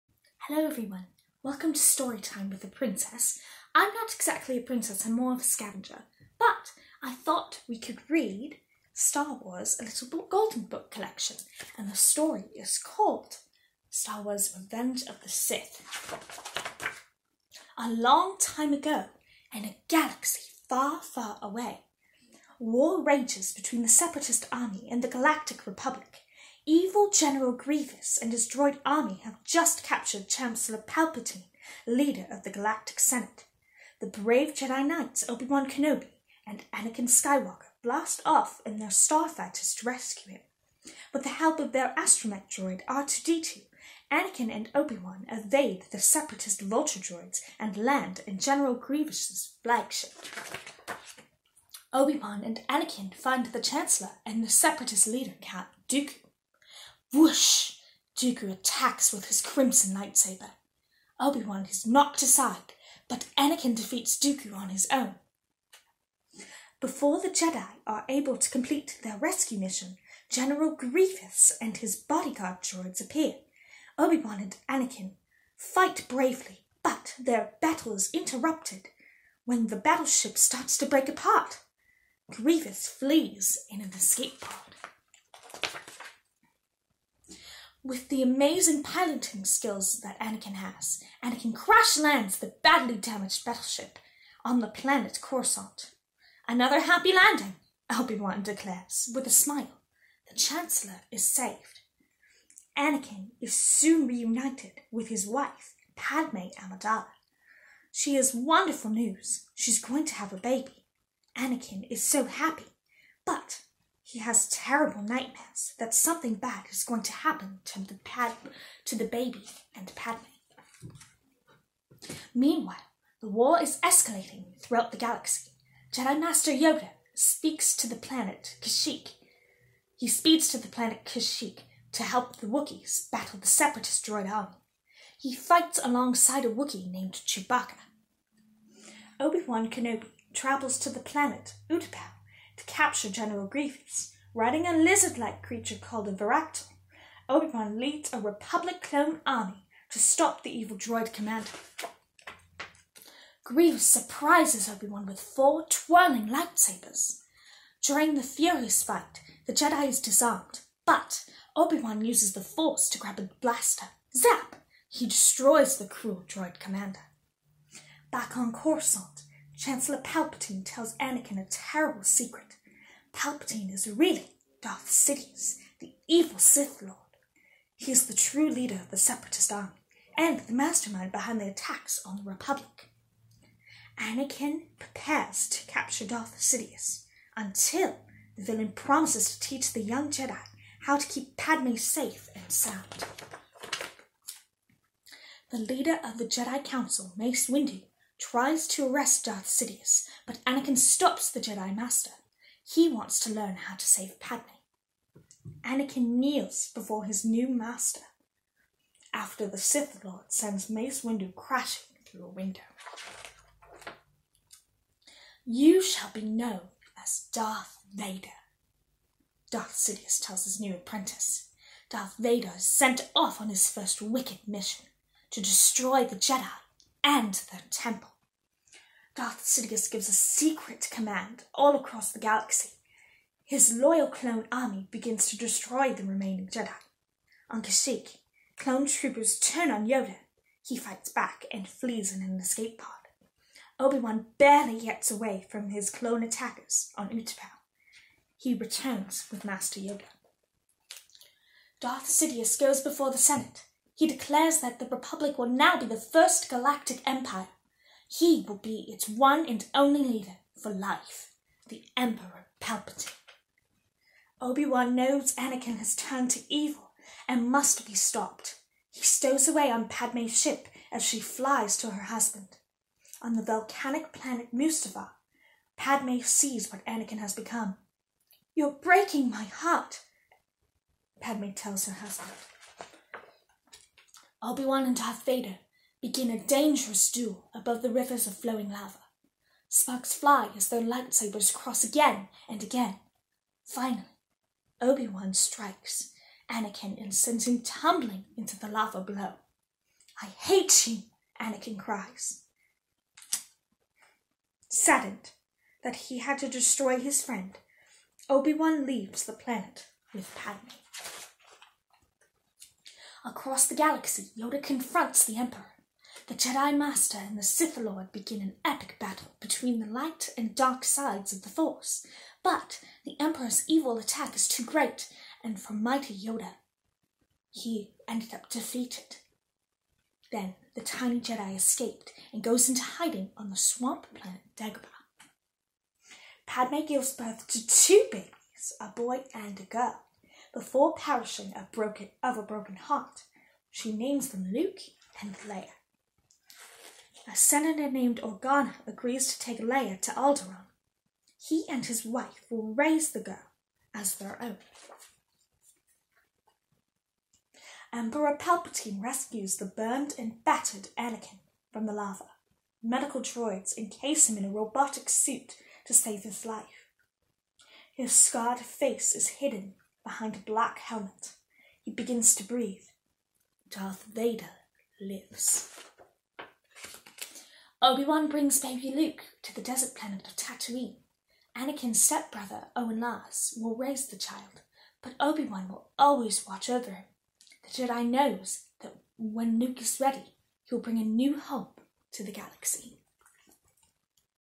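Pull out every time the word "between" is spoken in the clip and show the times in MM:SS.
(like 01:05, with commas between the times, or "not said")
00:23, 05:19.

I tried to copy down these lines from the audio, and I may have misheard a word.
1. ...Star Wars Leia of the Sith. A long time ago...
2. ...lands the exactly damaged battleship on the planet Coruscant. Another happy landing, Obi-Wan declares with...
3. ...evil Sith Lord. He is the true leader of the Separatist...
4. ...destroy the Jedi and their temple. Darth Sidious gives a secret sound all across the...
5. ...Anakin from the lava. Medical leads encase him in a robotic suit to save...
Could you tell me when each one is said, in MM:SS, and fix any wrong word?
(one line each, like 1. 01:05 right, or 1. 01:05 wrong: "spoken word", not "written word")
1. 00:13 wrong: "Revenge", not "Leia"
2. 01:31 wrong: "badly", not "exactly"
3. 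02:56 right
4. 03:45 wrong: "command", not "sound"
5. 06:00 wrong: "droids", not "leads".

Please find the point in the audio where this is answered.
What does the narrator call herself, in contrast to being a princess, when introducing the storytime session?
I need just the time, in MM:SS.
00:05.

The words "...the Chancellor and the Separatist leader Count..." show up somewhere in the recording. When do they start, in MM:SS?
00:53.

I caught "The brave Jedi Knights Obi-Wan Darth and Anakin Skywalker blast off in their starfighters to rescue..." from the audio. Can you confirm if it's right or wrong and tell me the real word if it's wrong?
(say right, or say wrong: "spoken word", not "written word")
wrong: "Kenobi", not "Darth".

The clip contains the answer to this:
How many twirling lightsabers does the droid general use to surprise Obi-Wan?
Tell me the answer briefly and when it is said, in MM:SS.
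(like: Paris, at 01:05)
4, at 02:35.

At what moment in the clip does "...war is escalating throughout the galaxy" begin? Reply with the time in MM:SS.
02:03.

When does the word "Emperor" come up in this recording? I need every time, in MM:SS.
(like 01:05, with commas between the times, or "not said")
04:21, 05:15, 05:23, 05:57.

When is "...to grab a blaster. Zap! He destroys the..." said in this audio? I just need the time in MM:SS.
02:42.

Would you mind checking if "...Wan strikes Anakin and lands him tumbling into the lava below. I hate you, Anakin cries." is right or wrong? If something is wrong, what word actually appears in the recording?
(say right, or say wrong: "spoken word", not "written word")
wrong: "sends", not "lands".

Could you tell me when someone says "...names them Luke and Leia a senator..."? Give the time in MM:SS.
05:43.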